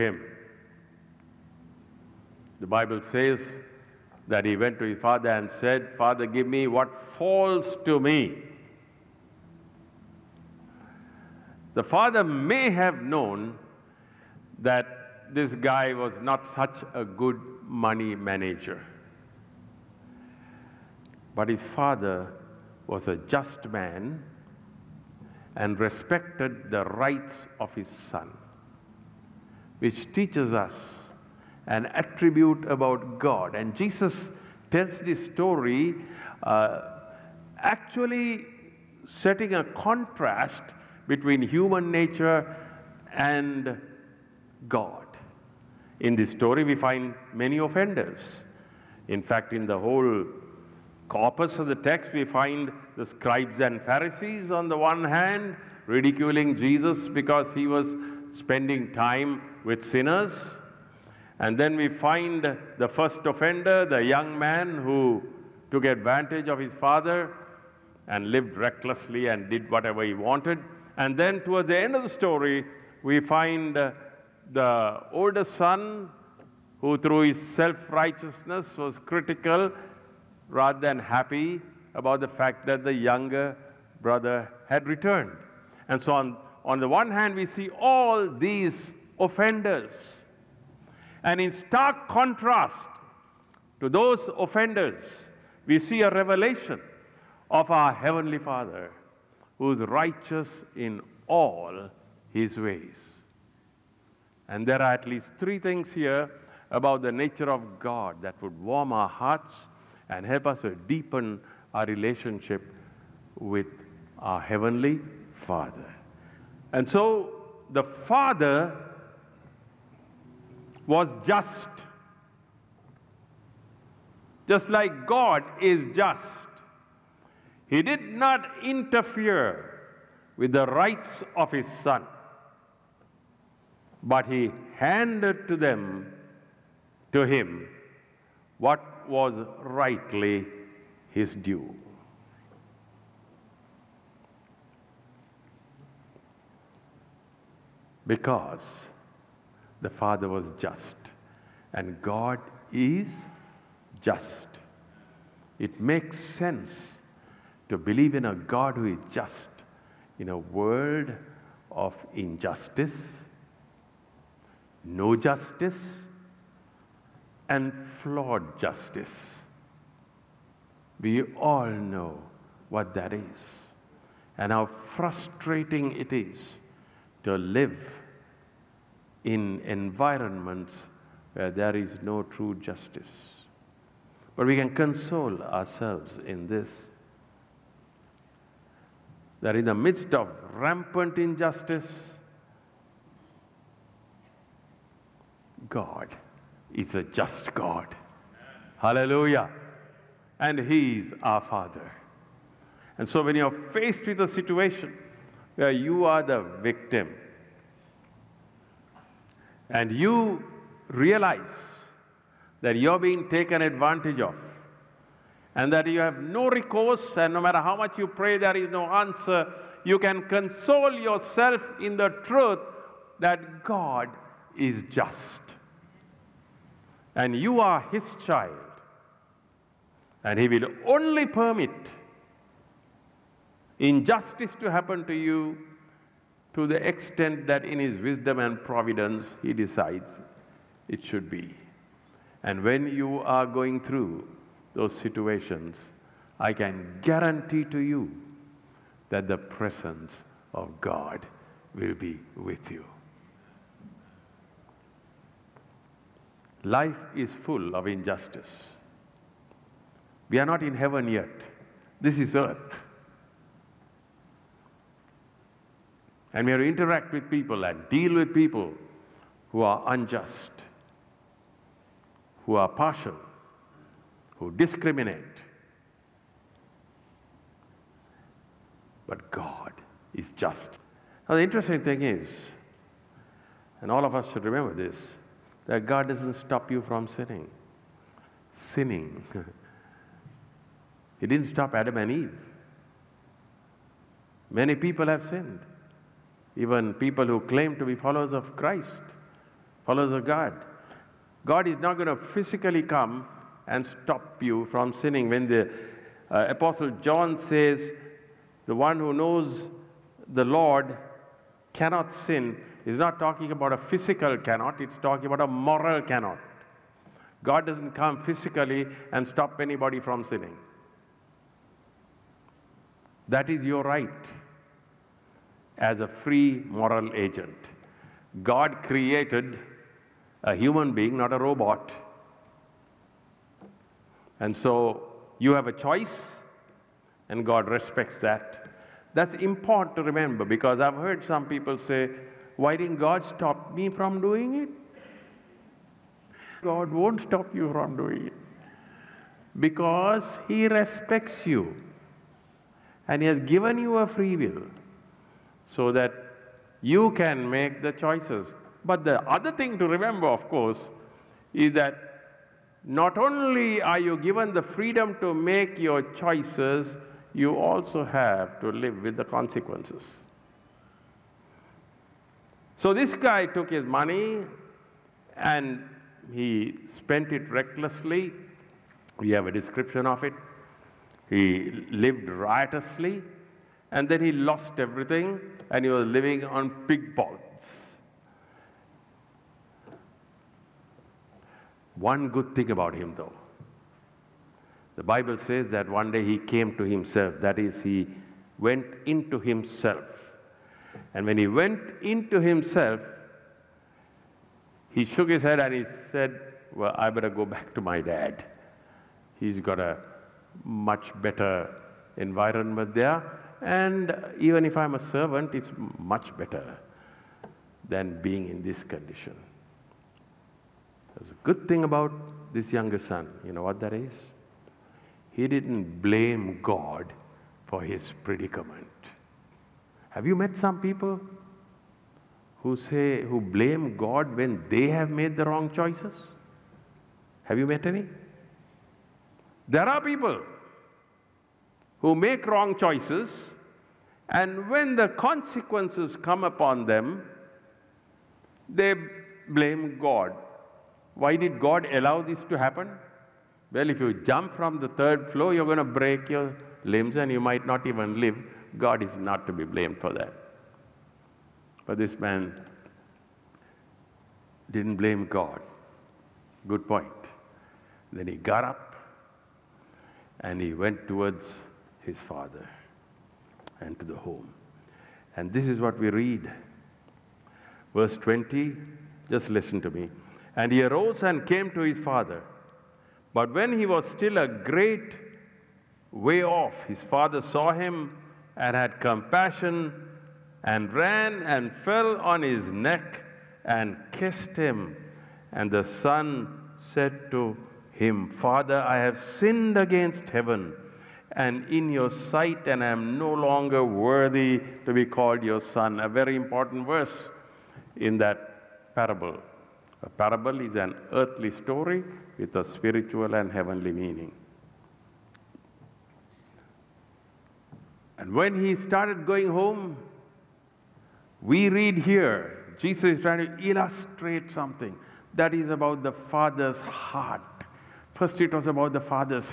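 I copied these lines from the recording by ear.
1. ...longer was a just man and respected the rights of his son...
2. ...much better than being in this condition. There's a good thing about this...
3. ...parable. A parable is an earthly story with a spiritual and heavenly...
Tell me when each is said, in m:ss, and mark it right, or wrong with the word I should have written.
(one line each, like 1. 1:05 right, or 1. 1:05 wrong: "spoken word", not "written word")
1. 0:21 wrong: "father", not "longer"
2. 6:55 right
3. 8:28 right.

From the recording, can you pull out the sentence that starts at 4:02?
And when you are going through those situations, I can guarantee to you that the presence of God will be with you.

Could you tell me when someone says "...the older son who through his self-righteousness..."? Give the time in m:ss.
1:14.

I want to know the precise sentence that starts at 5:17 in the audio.
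God doesn't come physically and stop anybody from sinning.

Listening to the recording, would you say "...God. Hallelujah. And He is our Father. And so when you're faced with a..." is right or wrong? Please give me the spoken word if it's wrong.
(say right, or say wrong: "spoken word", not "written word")
right.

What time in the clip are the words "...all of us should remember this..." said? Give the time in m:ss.
4:43.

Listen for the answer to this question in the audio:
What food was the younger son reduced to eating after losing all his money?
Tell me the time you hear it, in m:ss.
6:26.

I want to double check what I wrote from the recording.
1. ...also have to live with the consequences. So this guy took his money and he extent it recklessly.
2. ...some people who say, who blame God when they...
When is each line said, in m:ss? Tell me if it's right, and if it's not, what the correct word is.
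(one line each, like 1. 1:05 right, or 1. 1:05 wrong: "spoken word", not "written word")
1. 6:07 wrong: "spent", not "extent"
2. 7:10 right.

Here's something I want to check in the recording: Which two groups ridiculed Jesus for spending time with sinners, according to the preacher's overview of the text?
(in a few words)
scribes and Pharisees.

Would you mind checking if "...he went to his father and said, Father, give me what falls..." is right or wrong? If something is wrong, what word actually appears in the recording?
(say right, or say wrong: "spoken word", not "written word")
right.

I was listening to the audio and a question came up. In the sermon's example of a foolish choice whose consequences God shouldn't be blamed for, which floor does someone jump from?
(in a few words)
third floor.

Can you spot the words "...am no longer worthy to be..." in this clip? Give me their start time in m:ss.
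8:22.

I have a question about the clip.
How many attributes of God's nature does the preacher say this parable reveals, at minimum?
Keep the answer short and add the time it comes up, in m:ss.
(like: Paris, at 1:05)
3, at 1:45.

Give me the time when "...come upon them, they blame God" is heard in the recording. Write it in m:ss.
7:26.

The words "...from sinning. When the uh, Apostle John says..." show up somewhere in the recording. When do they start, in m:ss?
5:04.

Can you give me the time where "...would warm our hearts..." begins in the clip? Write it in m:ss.
1:48.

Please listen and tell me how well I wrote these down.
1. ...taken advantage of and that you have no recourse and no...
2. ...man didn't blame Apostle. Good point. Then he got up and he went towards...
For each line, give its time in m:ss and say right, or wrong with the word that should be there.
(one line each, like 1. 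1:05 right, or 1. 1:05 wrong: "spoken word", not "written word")
1. 3:33 right
2. 7:42 wrong: "God", not "Apostle".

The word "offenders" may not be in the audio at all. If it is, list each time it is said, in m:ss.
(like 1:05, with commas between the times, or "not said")
0:47, 1:03, 1:29, 1:34.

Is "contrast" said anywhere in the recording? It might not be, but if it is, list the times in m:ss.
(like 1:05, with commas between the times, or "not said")
0:39, 1:32.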